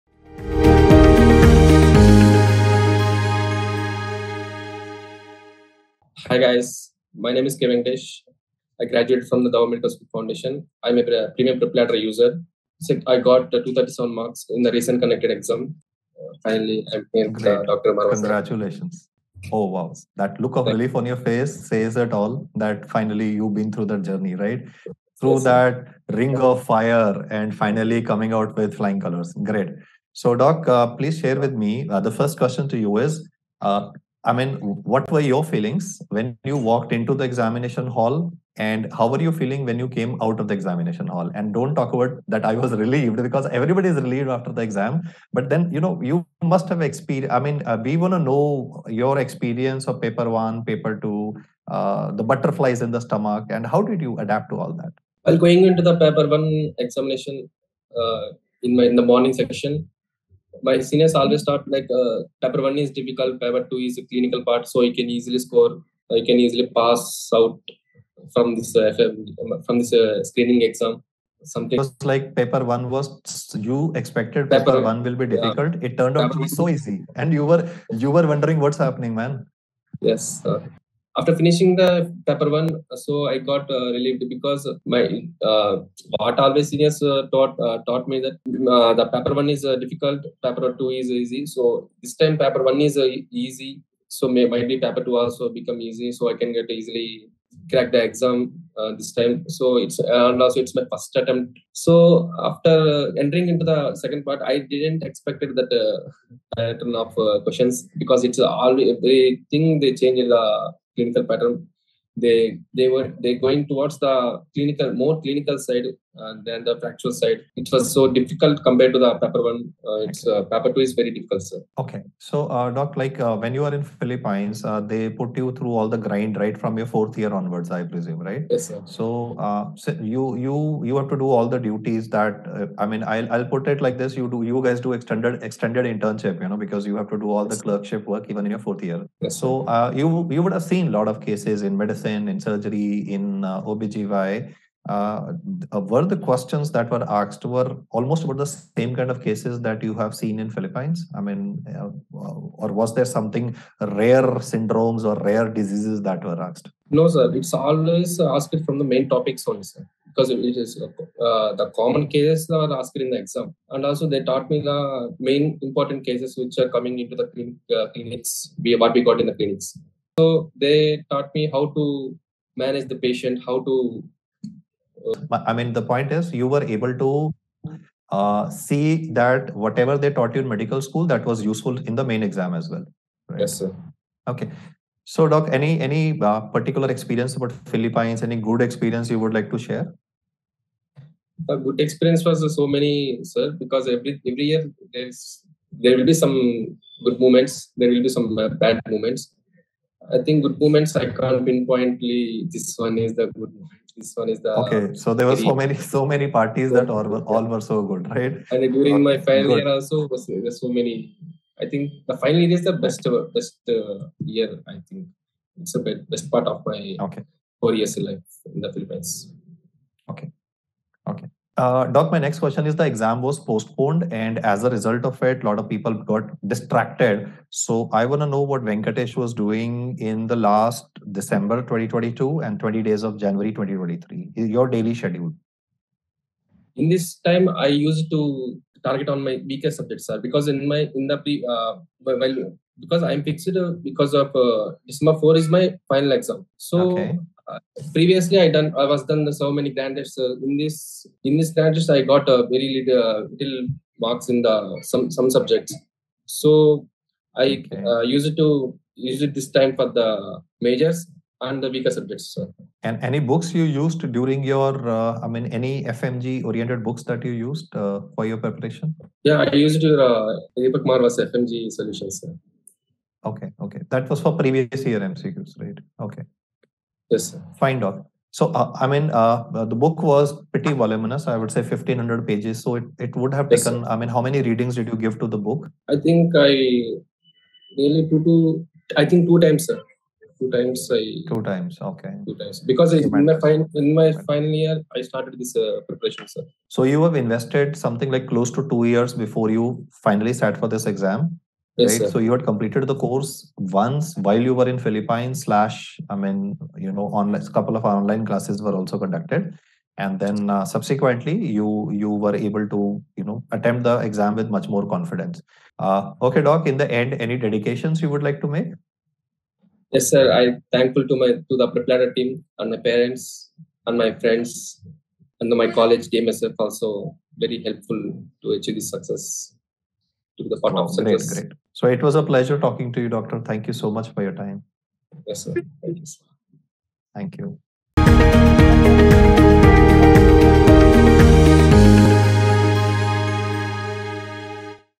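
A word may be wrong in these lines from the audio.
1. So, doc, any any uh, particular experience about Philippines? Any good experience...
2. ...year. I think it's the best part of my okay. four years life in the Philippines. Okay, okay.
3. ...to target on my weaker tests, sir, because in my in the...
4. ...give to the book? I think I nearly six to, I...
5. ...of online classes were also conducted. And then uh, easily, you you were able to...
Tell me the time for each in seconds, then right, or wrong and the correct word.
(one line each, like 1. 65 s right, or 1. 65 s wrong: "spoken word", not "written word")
1. 185 s right
2. 214 s right
3. 238 s wrong: "subjects", not "tests"
4. 284 s wrong: "two", not "six"
5. 307 s wrong: "subsequently", not "easily".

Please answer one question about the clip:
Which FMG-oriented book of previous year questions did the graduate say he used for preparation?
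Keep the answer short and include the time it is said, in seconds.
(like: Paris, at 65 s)
FMG Solutions, at 271 s.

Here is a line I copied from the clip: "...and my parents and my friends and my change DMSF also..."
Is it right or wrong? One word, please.
wrong.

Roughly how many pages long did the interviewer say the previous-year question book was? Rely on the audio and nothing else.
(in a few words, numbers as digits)
1500.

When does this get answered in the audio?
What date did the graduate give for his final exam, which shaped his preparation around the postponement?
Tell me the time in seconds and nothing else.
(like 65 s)
244 s.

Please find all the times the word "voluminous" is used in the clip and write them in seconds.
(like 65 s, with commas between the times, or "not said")
280 s.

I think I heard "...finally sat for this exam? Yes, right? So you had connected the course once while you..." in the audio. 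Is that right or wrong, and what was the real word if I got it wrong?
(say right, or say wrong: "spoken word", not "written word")
wrong: "completed", not "connected".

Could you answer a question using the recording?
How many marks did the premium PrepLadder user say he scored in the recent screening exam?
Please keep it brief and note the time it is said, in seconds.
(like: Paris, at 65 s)
237, at 13 s.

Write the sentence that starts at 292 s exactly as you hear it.
Because I, in my, fin- in my final year, I started this uh, preparation, sir.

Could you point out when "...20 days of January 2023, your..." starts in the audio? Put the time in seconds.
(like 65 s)
232 s.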